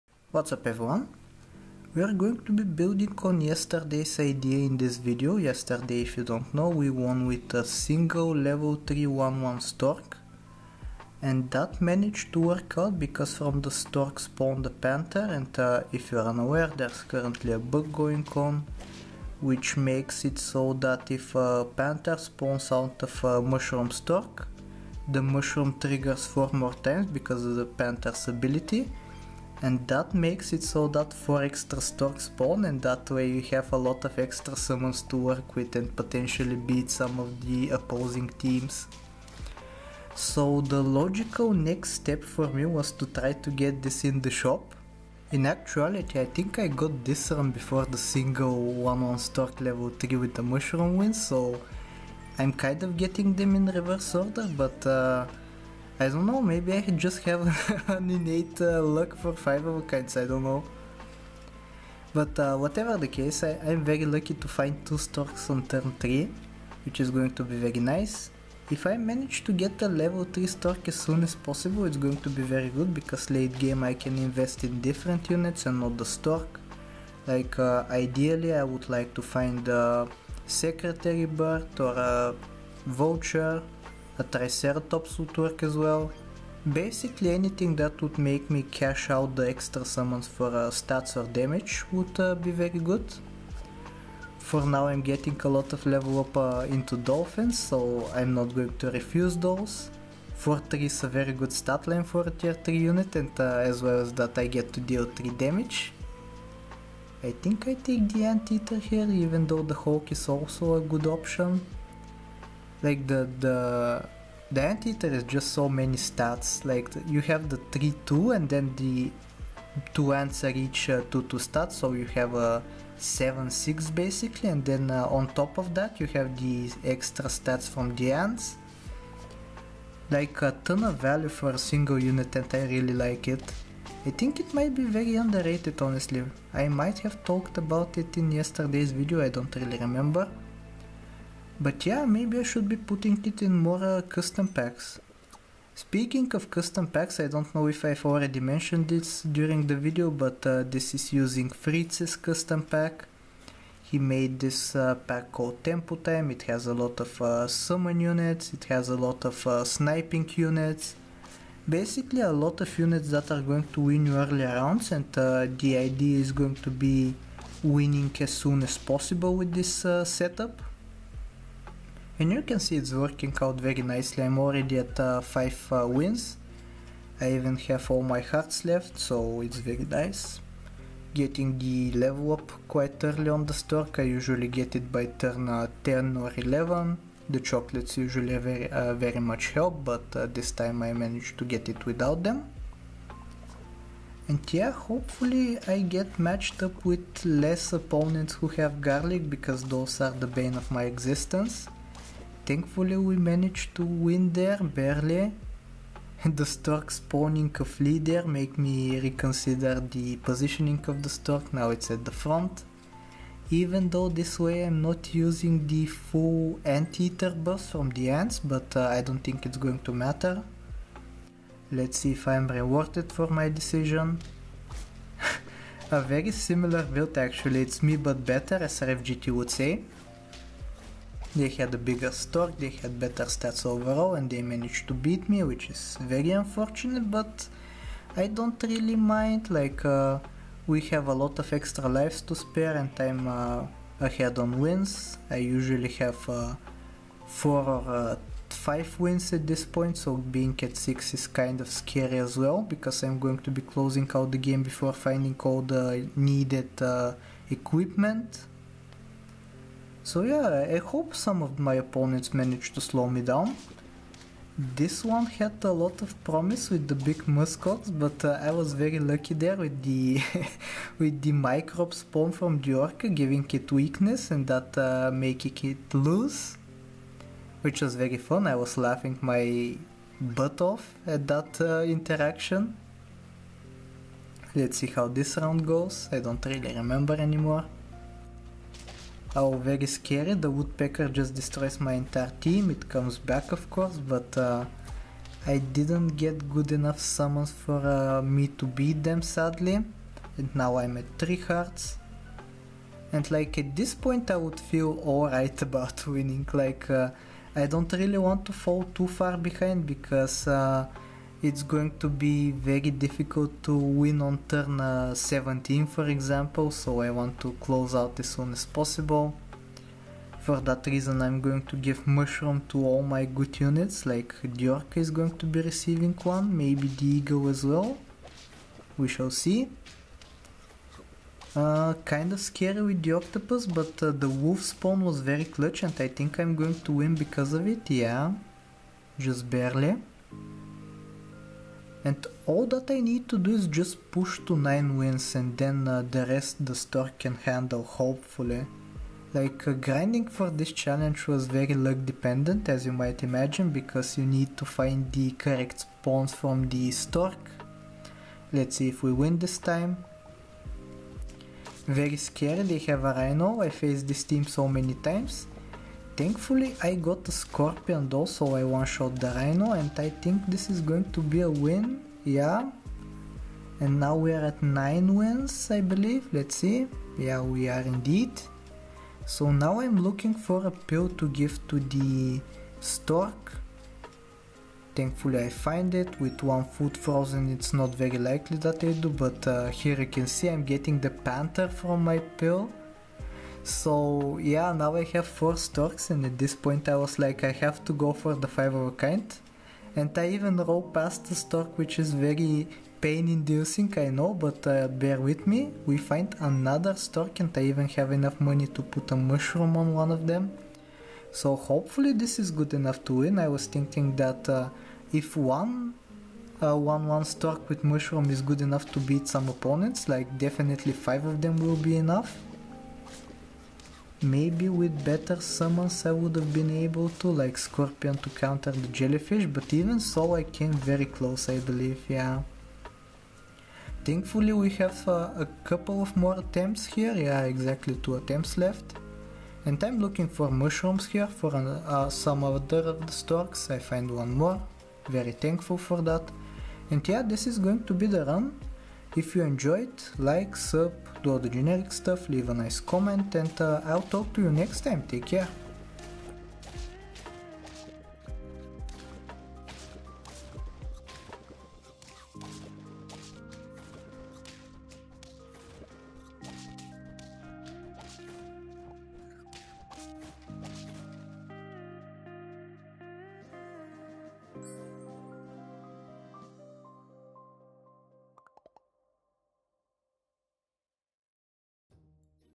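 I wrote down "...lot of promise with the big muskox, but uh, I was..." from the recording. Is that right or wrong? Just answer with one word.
right.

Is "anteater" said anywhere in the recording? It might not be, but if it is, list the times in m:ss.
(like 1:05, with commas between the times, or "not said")
1:48, 1:54, 3:36.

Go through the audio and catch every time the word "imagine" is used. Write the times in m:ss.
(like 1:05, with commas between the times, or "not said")
5:53.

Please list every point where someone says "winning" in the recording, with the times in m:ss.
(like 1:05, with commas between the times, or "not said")
2:47, 5:06.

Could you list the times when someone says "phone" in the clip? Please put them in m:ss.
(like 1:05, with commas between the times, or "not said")
not said.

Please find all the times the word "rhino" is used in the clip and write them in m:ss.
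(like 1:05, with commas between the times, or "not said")
6:03, 6:09.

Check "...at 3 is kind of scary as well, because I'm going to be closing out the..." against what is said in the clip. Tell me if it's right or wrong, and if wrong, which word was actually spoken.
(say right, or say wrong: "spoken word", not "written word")
wrong: "6", not "3".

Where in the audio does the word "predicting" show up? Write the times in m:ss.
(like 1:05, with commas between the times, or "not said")
not said.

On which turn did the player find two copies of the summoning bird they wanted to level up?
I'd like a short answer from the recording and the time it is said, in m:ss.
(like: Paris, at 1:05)
turn 3, at 1:05.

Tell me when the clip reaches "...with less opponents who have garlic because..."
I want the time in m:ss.
3:16.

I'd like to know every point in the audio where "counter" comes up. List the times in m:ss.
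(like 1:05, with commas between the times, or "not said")
7:08.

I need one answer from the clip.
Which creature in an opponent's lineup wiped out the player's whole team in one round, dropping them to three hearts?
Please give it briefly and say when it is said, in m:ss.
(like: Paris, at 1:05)
woodpecker, at 4:50.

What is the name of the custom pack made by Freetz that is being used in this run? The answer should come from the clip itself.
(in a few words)
Tempo Time.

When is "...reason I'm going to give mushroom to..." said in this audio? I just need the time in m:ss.
5:20.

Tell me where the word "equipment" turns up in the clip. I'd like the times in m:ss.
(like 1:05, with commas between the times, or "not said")
4:17.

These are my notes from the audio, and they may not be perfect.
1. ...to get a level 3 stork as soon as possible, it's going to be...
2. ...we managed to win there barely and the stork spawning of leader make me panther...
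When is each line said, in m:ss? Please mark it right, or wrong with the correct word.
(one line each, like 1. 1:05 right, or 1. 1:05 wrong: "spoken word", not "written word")
1. 1:09 right
2. 3:22 wrong: "reconsider", not "panther".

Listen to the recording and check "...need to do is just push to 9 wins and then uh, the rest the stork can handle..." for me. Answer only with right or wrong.
right.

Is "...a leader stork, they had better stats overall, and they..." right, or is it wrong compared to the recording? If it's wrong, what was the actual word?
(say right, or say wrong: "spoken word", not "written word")
wrong: "bigger", not "leader".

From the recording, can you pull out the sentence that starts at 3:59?
Like, uh, we have a lot of extra lives to spare, and I'm uh, ahead on wins.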